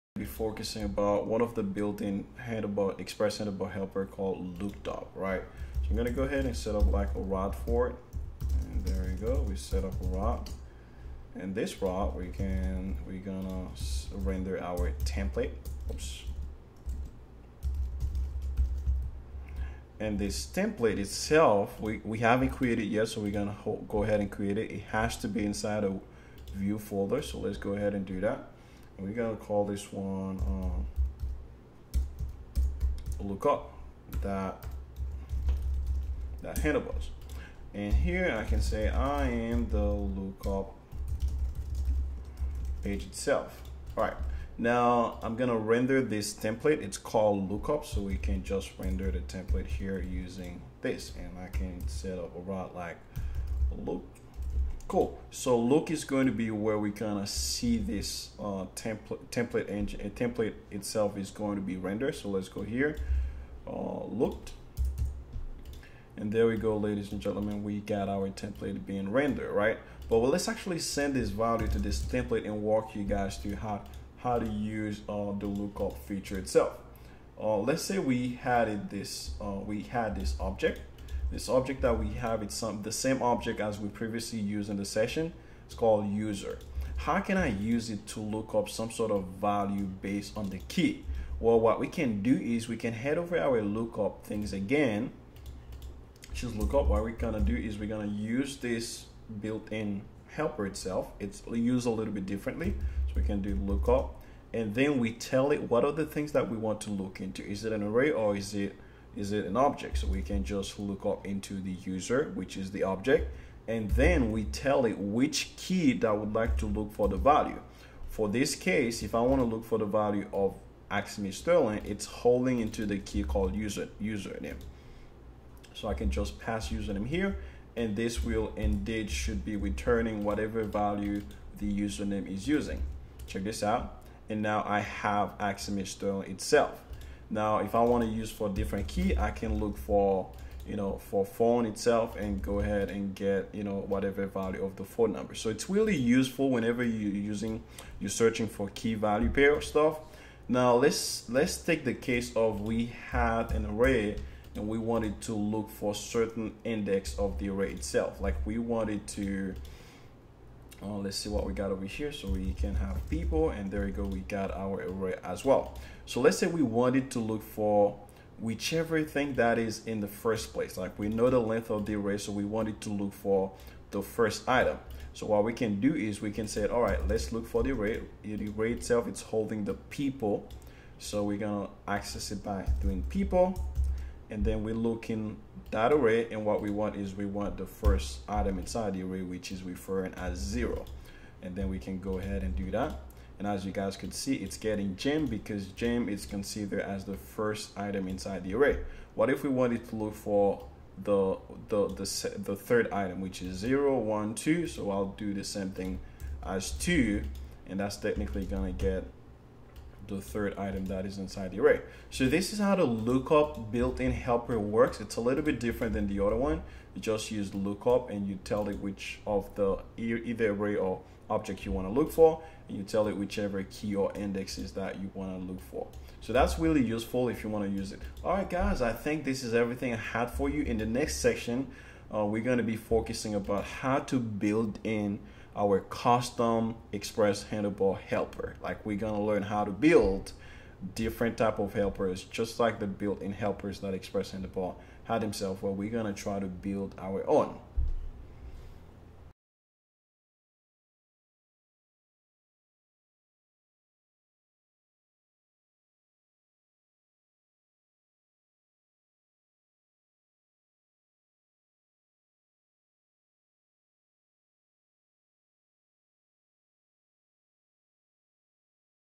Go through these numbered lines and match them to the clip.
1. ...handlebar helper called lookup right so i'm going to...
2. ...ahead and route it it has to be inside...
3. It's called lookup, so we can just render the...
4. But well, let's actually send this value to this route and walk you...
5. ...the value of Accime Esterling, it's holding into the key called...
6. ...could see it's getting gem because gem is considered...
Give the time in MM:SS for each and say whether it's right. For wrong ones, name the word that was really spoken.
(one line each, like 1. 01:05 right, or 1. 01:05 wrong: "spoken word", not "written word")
1. 00:03 right
2. 00:24 wrong: "create", not "route"
3. 00:46 right
4. 01:10 wrong: "template", not "route"
5. 01:59 right
6. 03:13 right.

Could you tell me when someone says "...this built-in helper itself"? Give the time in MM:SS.
01:38.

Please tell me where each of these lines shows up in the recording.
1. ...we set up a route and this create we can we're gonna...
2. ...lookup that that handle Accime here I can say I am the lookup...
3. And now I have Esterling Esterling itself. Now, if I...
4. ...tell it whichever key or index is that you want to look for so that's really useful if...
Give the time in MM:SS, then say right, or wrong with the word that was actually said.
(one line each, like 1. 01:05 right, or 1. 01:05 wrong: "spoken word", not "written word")
1. 00:09 wrong: "route", not "create"
2. 00:33 wrong: "And", not "Accime"
3. 02:14 wrong: "Accime", not "Esterling"
4. 03:42 right.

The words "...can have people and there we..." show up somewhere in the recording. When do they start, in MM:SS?
02:42.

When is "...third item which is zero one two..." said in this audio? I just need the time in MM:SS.
03:22.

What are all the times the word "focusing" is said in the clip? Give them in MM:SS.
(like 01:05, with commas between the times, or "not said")
00:00, 03:52.